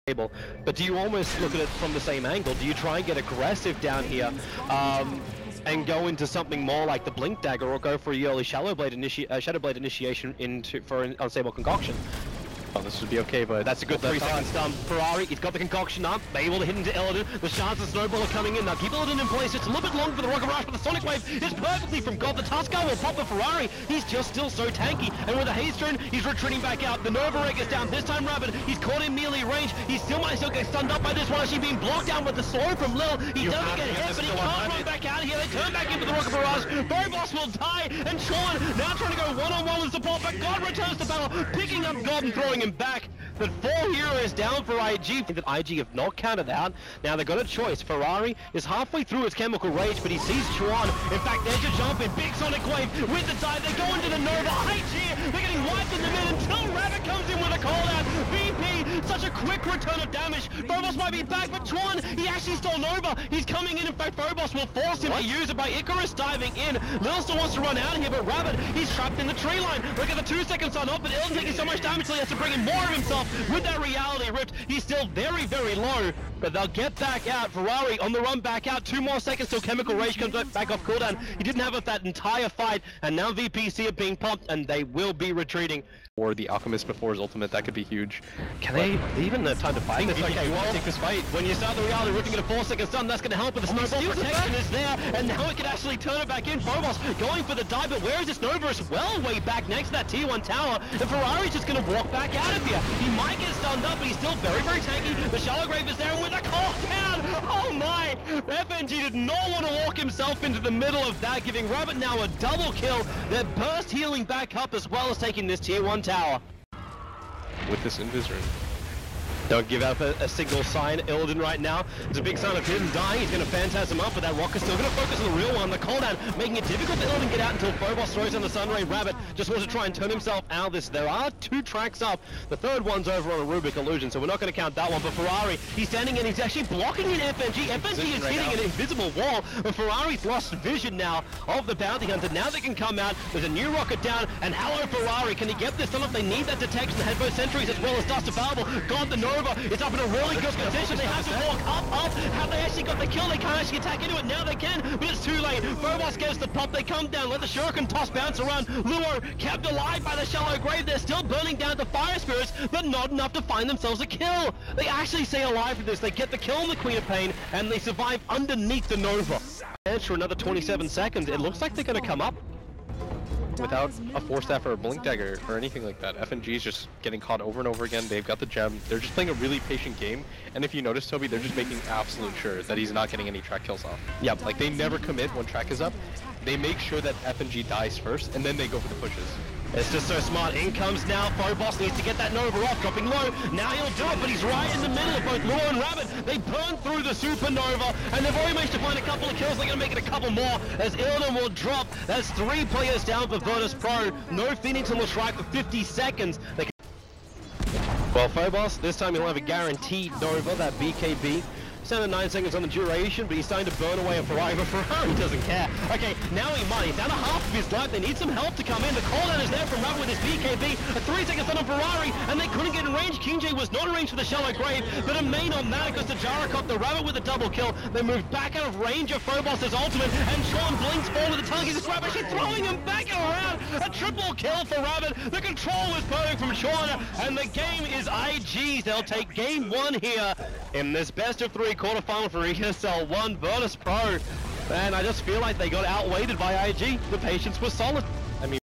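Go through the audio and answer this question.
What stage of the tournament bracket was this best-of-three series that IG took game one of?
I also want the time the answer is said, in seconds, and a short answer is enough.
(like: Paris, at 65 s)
Quarterfinal, at 241 s.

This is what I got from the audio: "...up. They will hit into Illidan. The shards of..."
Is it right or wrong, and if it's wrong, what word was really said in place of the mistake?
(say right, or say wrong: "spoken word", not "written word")
right.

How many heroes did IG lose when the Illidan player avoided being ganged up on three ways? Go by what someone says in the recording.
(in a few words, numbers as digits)
4.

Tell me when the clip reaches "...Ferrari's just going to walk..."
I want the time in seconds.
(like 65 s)
101 s.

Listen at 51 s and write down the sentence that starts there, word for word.
In fact, there's a jump in Big Sonic Wave with the dive.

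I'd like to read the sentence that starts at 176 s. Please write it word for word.
FNG is just getting caught over and over again.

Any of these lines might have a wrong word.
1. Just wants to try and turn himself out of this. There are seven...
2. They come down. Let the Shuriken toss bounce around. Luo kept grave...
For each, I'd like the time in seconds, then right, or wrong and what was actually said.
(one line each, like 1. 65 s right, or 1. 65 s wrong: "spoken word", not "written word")
1. 129 s wrong: "two", not "seven"
2. 156 s wrong: "alive", not "grave".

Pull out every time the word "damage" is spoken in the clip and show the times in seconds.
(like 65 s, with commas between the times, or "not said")
60 s, 71 s.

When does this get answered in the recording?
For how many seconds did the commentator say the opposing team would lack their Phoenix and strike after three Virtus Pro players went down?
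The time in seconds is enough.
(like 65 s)
204 s.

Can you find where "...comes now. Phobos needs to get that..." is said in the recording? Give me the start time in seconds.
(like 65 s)
190 s.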